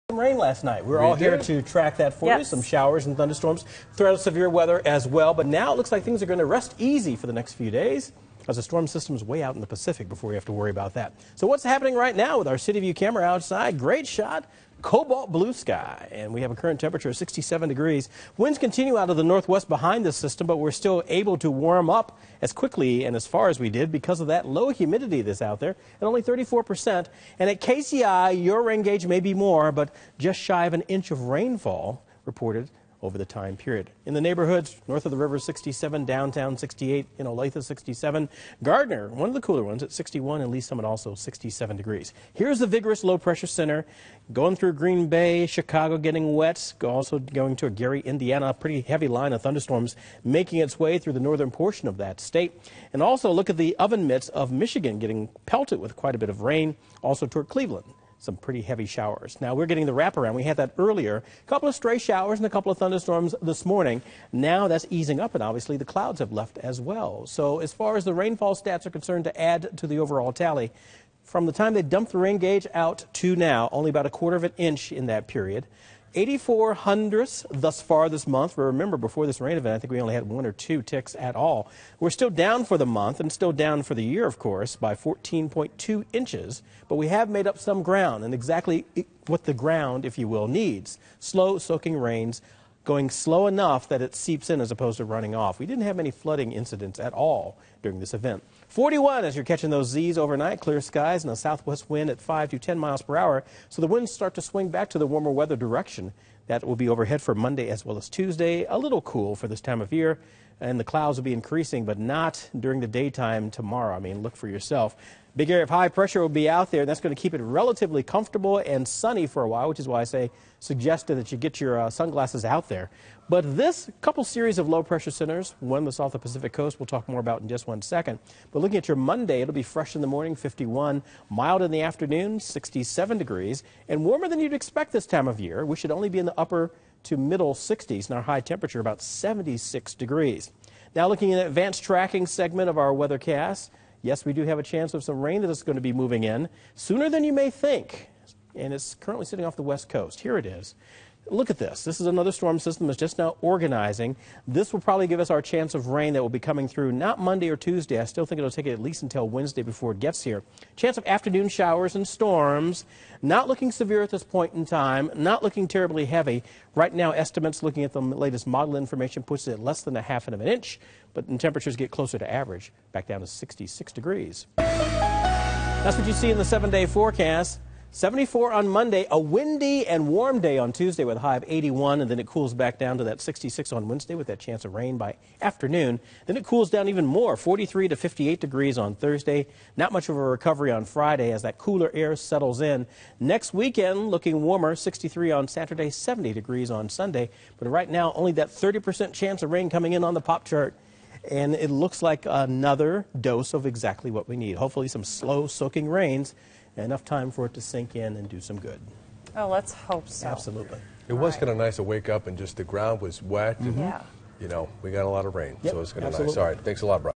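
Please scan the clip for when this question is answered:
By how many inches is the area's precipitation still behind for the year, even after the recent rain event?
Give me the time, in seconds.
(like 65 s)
84 s.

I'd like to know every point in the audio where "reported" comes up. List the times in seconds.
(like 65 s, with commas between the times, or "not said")
32 s.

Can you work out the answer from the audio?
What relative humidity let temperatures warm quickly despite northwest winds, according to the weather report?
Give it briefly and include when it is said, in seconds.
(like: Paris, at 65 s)
34%, at 26 s.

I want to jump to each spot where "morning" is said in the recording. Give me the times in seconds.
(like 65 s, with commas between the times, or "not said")
63 s, 130 s.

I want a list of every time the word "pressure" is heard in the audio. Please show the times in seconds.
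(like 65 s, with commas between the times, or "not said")
43 s, 115 s, 124 s.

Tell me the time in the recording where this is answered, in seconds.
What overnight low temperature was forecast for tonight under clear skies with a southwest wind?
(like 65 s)
98 s.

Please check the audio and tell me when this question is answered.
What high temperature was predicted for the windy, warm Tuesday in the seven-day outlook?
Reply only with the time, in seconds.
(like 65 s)
181 s.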